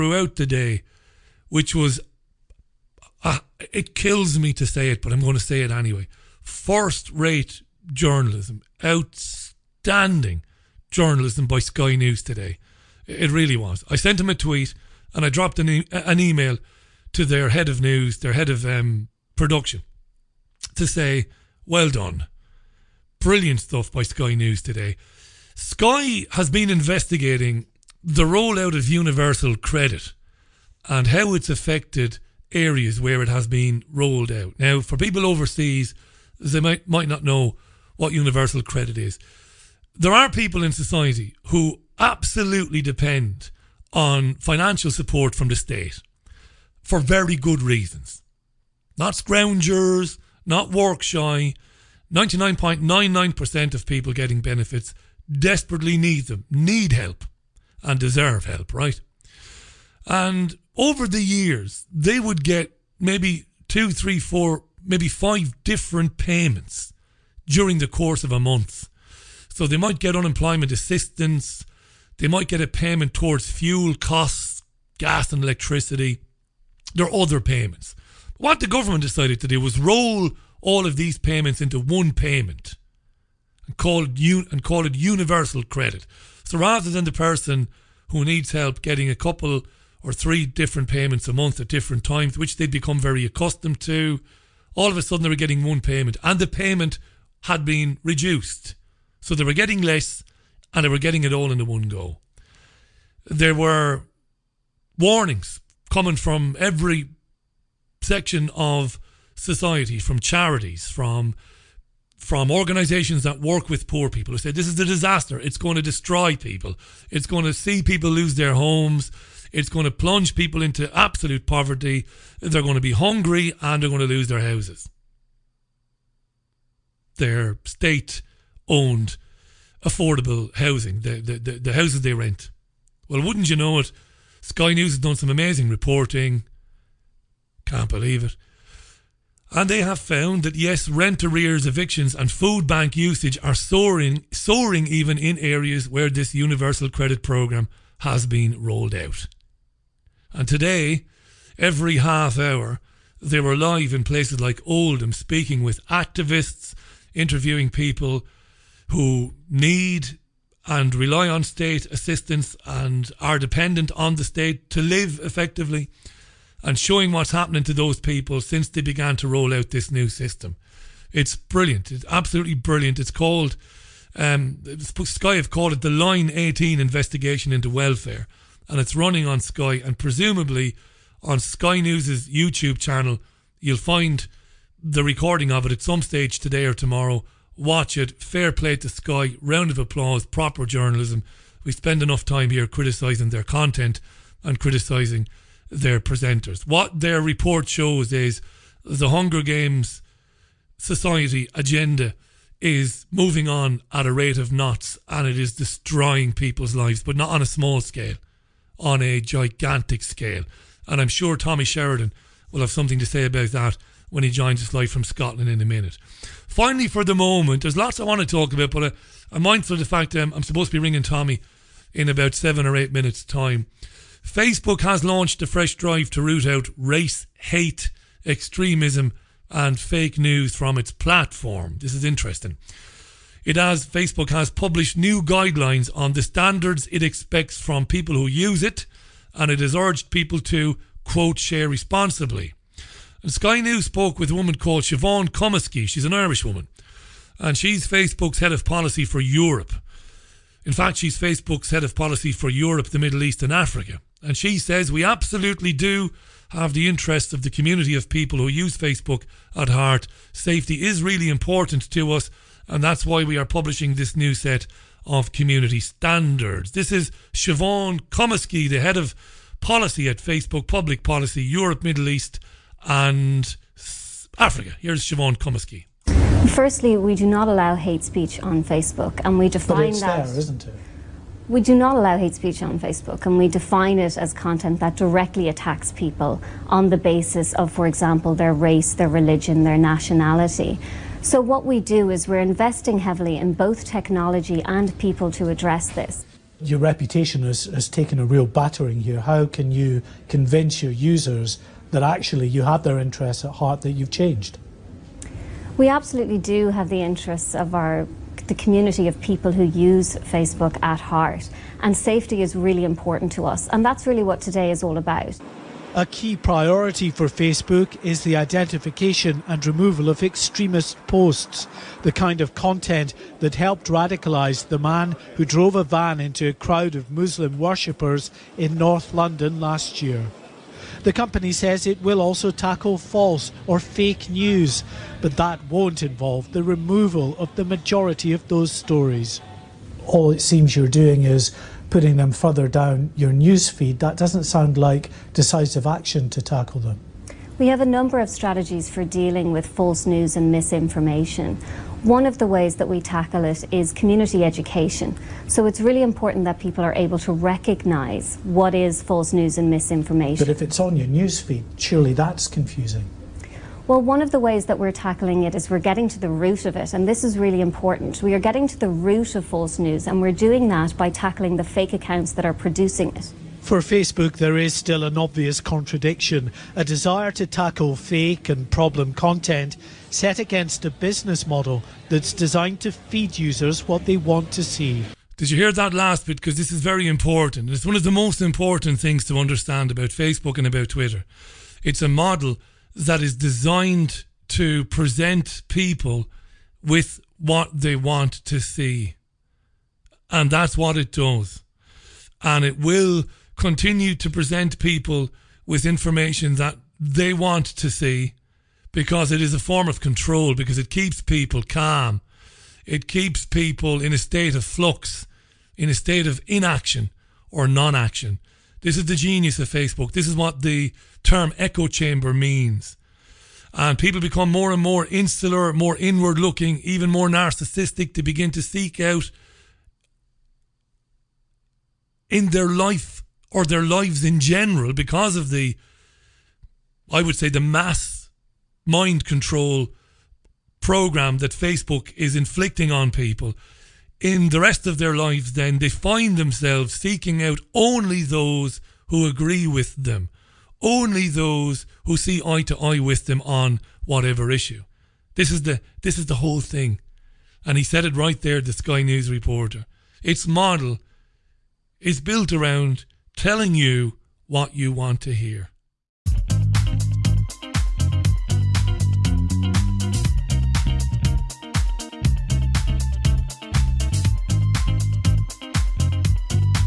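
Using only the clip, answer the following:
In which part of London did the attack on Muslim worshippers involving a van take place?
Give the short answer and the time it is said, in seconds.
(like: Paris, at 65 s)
North London, at 328 s.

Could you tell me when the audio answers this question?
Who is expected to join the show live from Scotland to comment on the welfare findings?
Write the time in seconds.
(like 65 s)
211 s.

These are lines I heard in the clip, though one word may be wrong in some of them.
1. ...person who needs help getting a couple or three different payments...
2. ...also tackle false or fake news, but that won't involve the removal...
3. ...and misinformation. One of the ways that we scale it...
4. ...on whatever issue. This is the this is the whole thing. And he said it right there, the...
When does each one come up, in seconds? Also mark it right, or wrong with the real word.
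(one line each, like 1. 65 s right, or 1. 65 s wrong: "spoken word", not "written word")
1. 87 s right
2. 332 s right
3. 350 s wrong: "tackle", not "scale"
4. 453 s right.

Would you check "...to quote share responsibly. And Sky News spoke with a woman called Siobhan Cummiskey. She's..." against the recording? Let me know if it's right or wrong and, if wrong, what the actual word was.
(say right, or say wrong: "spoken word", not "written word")
right.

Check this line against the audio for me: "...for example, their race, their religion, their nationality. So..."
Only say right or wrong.
right.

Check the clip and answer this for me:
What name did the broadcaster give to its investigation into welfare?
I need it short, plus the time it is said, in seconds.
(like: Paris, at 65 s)
Line 18, at 175 s.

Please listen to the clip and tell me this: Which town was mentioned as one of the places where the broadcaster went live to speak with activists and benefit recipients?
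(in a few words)
Oldham.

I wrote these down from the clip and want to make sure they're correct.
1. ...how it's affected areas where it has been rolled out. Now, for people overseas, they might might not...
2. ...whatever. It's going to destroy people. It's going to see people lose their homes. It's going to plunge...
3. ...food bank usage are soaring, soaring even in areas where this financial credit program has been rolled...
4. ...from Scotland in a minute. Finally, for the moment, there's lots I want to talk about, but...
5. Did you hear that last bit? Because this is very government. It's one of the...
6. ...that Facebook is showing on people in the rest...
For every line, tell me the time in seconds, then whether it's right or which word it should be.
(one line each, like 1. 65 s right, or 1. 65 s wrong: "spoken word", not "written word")
1. 31 s right
2. 114 s wrong: "disaster", not "whatever"
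3. 142 s wrong: "universal", not "financial"
4. 214 s right
5. 385 s wrong: "important", not "government"
6. 441 s wrong: "inflicting", not "showing".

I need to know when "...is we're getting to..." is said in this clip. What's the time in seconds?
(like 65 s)
365 s.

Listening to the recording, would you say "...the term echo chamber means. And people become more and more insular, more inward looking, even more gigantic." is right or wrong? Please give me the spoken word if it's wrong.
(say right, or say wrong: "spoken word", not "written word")
wrong: "narcissistic", not "gigantic".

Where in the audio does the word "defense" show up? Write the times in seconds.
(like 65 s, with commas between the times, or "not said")
not said.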